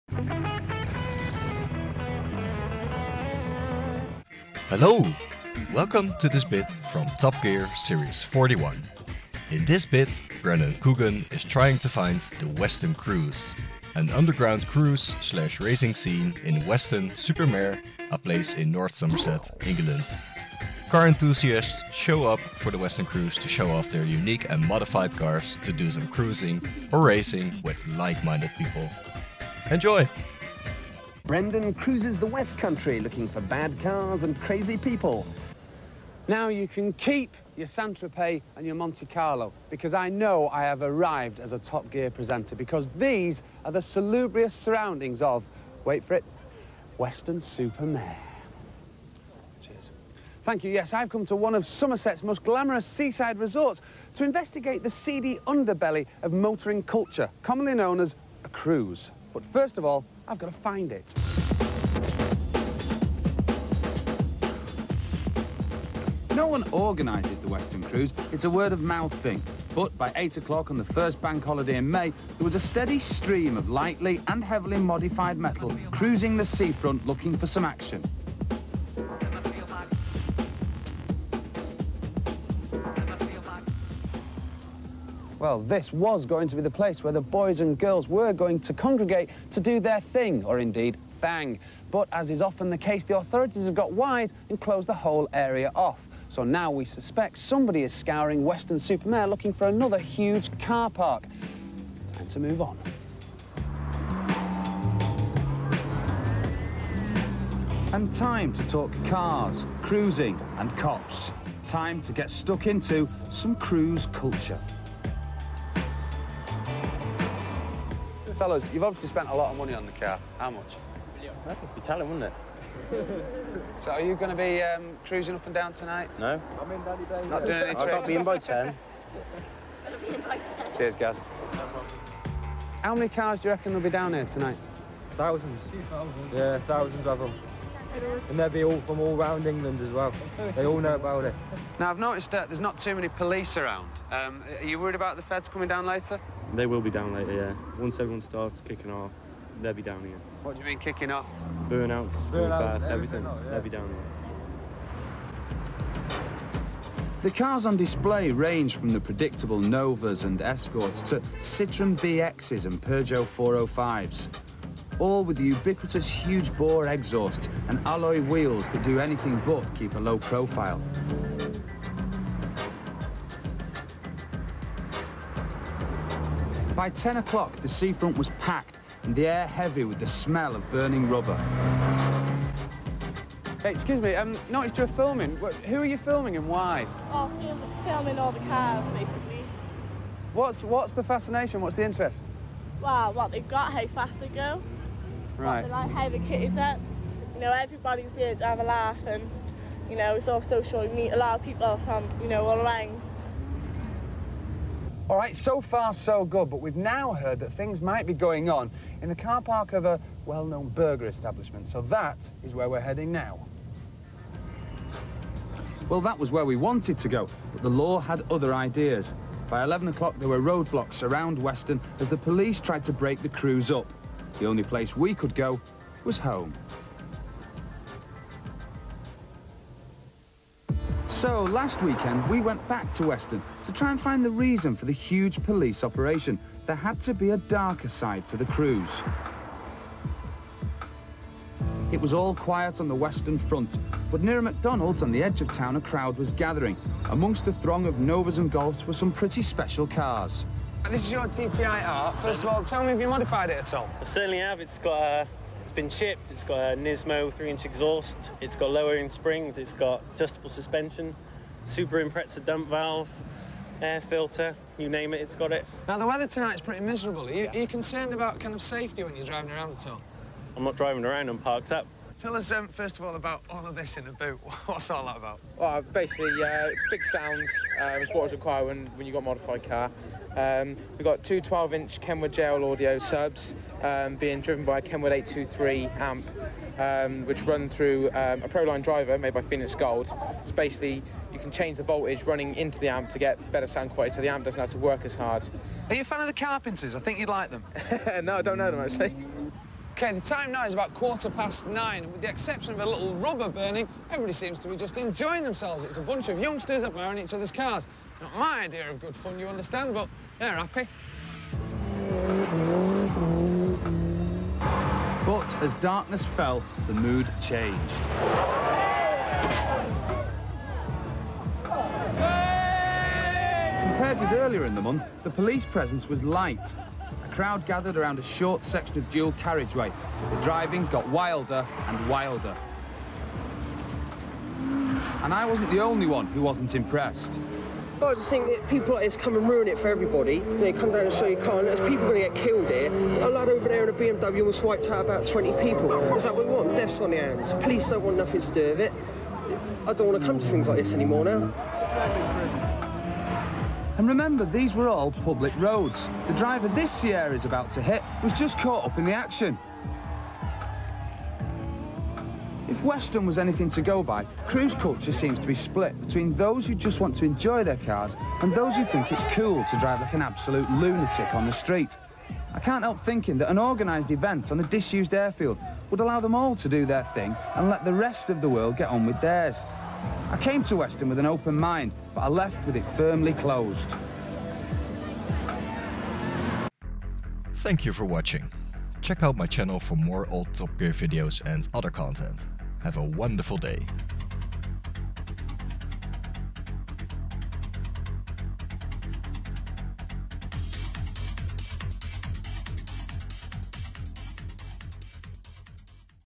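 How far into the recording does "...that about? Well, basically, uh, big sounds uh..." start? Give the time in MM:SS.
04:35.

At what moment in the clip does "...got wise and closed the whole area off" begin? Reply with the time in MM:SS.
01:33.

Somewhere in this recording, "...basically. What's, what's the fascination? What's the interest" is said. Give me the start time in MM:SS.
03:08.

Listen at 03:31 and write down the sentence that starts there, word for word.
So that is where we're heading now.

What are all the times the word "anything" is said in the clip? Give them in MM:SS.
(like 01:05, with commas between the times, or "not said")
02:48, 06:03.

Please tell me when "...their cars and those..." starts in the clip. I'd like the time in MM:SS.
06:07.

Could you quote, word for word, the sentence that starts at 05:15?
But as darkness fell, the mood changed.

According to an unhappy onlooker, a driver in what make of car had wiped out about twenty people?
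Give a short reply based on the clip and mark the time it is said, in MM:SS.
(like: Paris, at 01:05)
BMW, at 05:43.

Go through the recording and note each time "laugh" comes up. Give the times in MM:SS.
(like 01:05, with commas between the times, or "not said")
03:18.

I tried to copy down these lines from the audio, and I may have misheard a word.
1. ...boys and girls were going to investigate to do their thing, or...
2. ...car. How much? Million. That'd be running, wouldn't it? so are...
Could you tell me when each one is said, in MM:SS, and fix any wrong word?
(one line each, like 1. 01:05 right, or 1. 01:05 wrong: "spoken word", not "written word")
1. 01:27 wrong: "congregate", not "investigate"
2. 01:59 wrong: "telling", not "running".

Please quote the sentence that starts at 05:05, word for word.
It's a bunch of youngsters admiring each other's cars.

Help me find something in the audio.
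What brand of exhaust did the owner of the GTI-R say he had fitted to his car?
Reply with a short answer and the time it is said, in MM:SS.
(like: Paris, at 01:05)
Nismo, at 04:16.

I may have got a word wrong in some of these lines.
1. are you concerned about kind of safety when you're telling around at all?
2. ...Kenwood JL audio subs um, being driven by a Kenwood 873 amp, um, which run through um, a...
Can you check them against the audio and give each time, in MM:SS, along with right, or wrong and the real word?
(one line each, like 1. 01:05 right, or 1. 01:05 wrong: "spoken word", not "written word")
1. 04:27 wrong: "driving", not "telling"
2. 04:41 wrong: "823", not "873".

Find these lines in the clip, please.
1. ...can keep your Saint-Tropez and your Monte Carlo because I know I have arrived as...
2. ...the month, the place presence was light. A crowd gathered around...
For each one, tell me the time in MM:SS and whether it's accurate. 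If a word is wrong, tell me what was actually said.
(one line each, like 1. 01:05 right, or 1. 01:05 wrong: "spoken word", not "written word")
1. 00:36 right
2. 05:24 wrong: "police", not "place".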